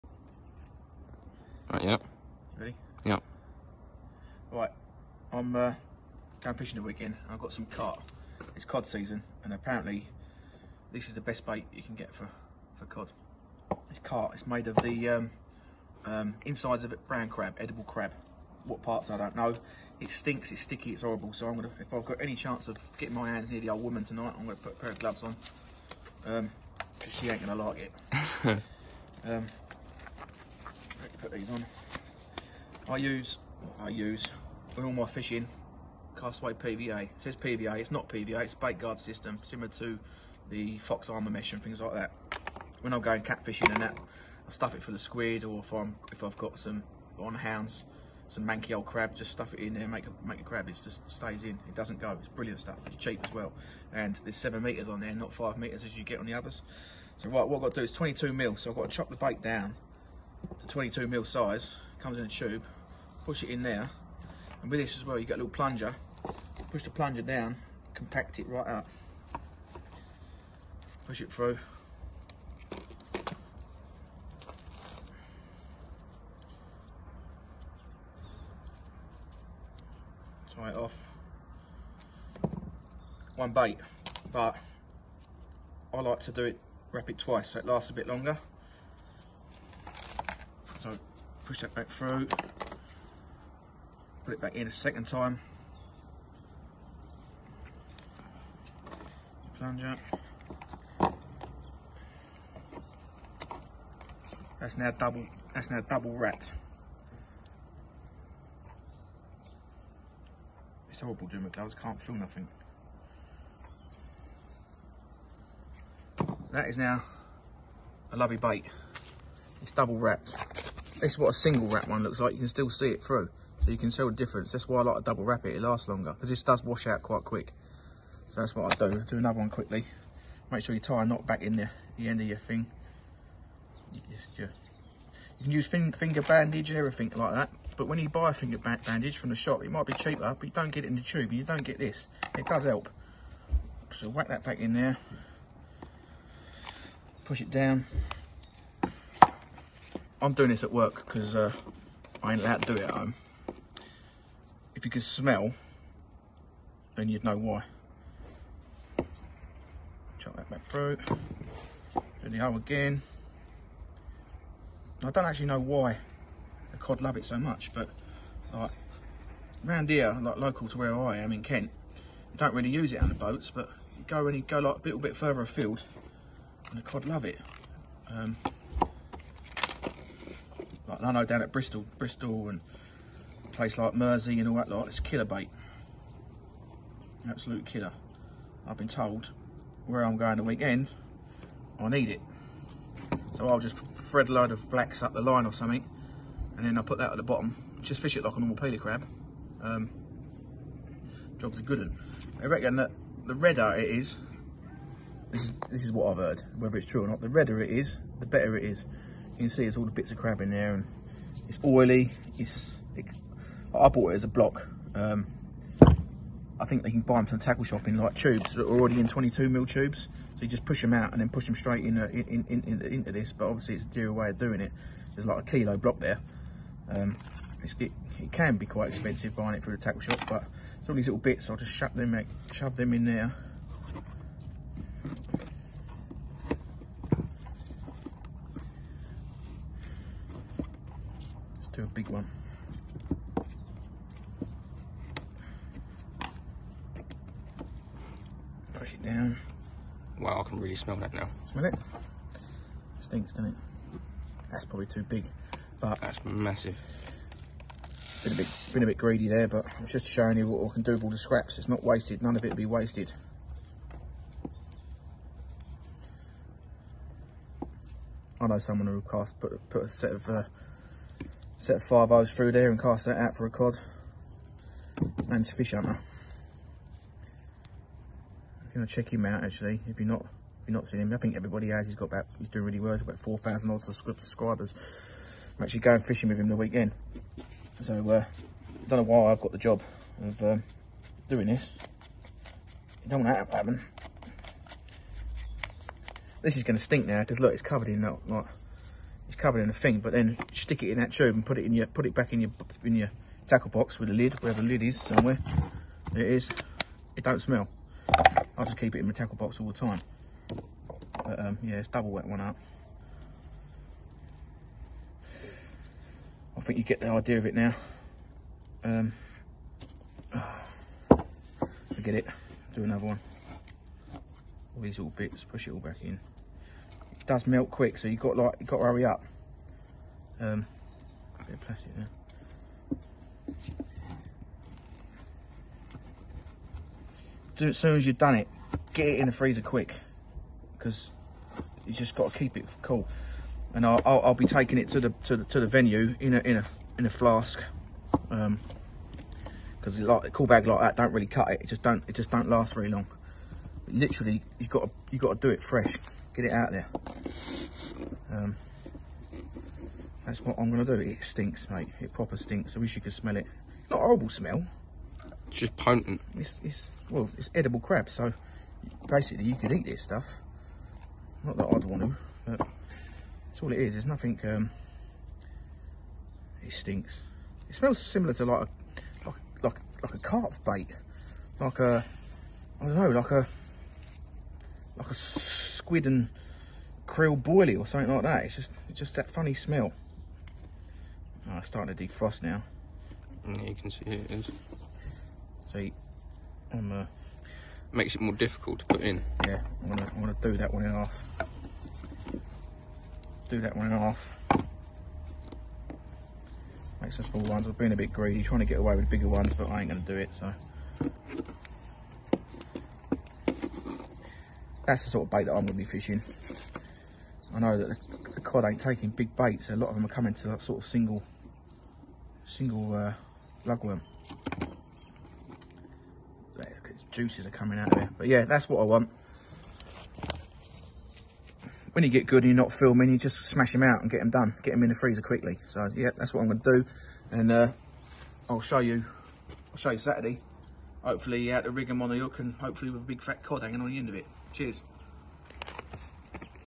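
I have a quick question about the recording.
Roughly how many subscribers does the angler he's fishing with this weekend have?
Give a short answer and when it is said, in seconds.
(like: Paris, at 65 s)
4,000, at 283 s.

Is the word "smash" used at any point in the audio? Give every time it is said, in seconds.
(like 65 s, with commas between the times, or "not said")
433 s.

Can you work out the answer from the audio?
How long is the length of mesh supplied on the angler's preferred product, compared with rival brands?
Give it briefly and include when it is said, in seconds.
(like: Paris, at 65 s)
7 meters, at 54 s.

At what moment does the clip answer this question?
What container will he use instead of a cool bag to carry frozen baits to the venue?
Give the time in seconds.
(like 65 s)
347 s.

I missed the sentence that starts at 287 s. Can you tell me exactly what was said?
So uh, I don't know why I've got the job of um, doing this.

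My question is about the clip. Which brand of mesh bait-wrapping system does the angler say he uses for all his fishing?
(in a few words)
Castaway PVA.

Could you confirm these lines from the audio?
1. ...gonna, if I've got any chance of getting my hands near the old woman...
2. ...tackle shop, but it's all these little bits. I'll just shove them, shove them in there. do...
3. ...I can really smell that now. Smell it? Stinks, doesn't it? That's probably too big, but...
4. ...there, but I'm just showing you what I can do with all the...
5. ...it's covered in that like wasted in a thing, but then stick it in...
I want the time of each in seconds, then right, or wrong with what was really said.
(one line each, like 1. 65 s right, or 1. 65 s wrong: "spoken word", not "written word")
1. 21 s right
2. 229 s right
3. 250 s right
4. 259 s right
5. 297 s wrong: "covered", not "wasted".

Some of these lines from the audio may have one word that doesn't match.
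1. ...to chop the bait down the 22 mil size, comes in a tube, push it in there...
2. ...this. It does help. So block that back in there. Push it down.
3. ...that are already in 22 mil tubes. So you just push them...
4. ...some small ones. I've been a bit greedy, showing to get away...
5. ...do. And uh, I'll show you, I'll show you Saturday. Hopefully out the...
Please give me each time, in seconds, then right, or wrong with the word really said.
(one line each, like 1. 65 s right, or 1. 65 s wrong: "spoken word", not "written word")
1. 58 s right
2. 141 s wrong: "whack", not "block"
3. 218 s right
4. 407 s wrong: "trying", not "showing"
5. 436 s right.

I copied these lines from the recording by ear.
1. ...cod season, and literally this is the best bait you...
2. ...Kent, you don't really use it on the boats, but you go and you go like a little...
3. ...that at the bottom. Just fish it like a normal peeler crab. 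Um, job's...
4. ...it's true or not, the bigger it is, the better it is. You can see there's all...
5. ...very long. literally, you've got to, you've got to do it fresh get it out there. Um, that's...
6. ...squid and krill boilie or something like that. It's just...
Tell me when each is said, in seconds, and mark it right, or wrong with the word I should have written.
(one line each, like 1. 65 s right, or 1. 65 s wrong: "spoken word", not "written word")
1. 8 s wrong: "apparently", not "literally"
2. 171 s right
3. 196 s right
4. 206 s wrong: "redder", not "bigger"
5. 352 s right
6. 385 s right.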